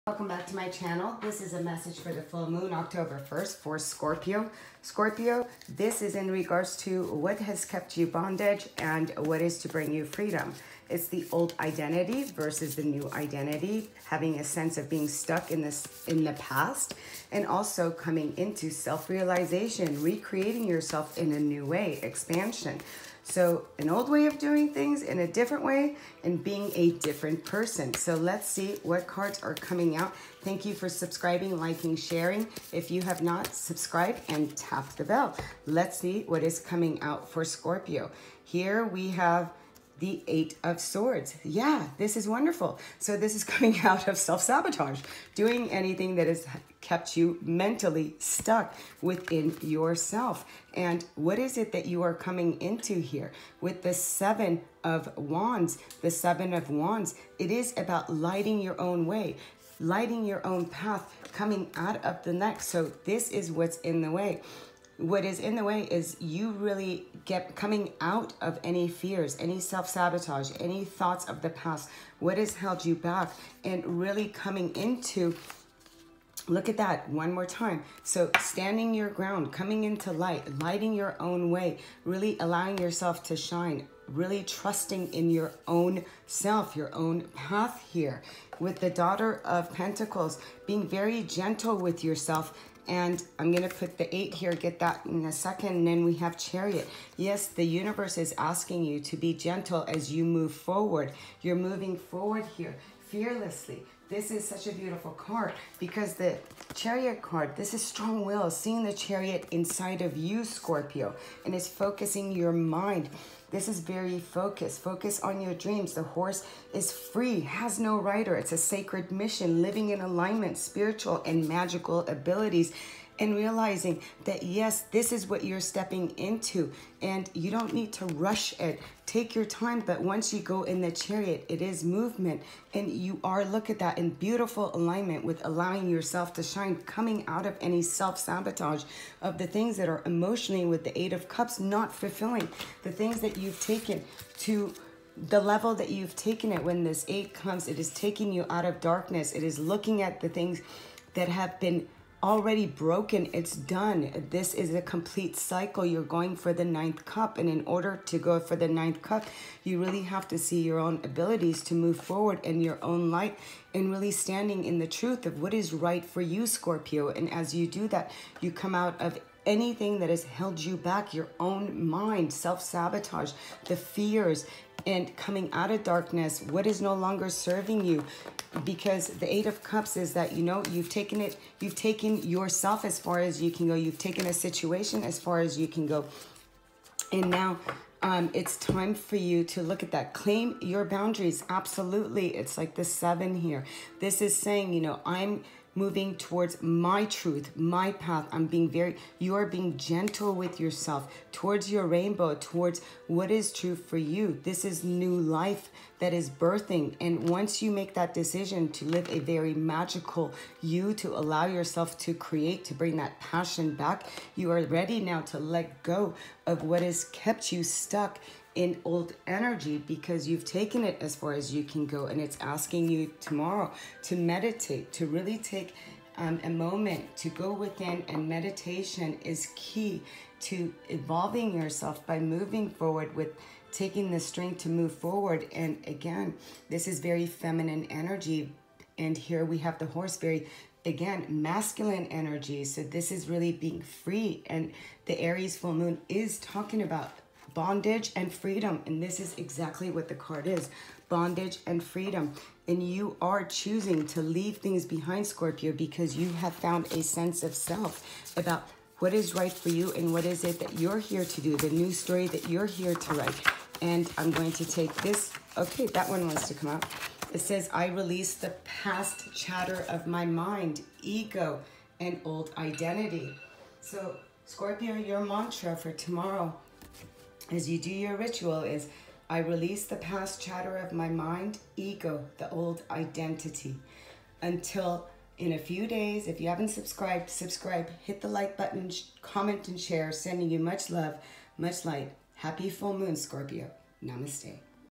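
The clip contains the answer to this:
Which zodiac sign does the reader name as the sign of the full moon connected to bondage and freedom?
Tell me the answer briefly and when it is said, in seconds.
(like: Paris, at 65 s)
Aries, at 245 s.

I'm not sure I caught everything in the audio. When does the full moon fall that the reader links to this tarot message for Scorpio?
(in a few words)
October 1st.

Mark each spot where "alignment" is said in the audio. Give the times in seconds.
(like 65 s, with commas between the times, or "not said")
119 s, 134 s.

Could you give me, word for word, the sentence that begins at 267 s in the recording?
It says, I release the past chatter of my mind, ego, and old identity.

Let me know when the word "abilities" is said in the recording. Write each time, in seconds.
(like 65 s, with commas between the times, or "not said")
122 s, 161 s.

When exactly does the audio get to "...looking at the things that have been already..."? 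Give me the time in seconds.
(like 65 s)
149 s.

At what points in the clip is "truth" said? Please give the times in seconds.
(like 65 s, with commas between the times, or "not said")
164 s, 197 s.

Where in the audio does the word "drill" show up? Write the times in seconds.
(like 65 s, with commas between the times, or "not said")
not said.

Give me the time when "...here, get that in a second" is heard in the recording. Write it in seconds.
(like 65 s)
94 s.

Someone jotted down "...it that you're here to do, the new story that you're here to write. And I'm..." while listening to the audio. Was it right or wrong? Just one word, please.
right.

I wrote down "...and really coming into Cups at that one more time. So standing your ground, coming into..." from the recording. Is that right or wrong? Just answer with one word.
wrong.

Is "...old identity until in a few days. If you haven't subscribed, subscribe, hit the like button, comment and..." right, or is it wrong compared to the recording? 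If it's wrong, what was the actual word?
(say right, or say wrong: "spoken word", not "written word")
right.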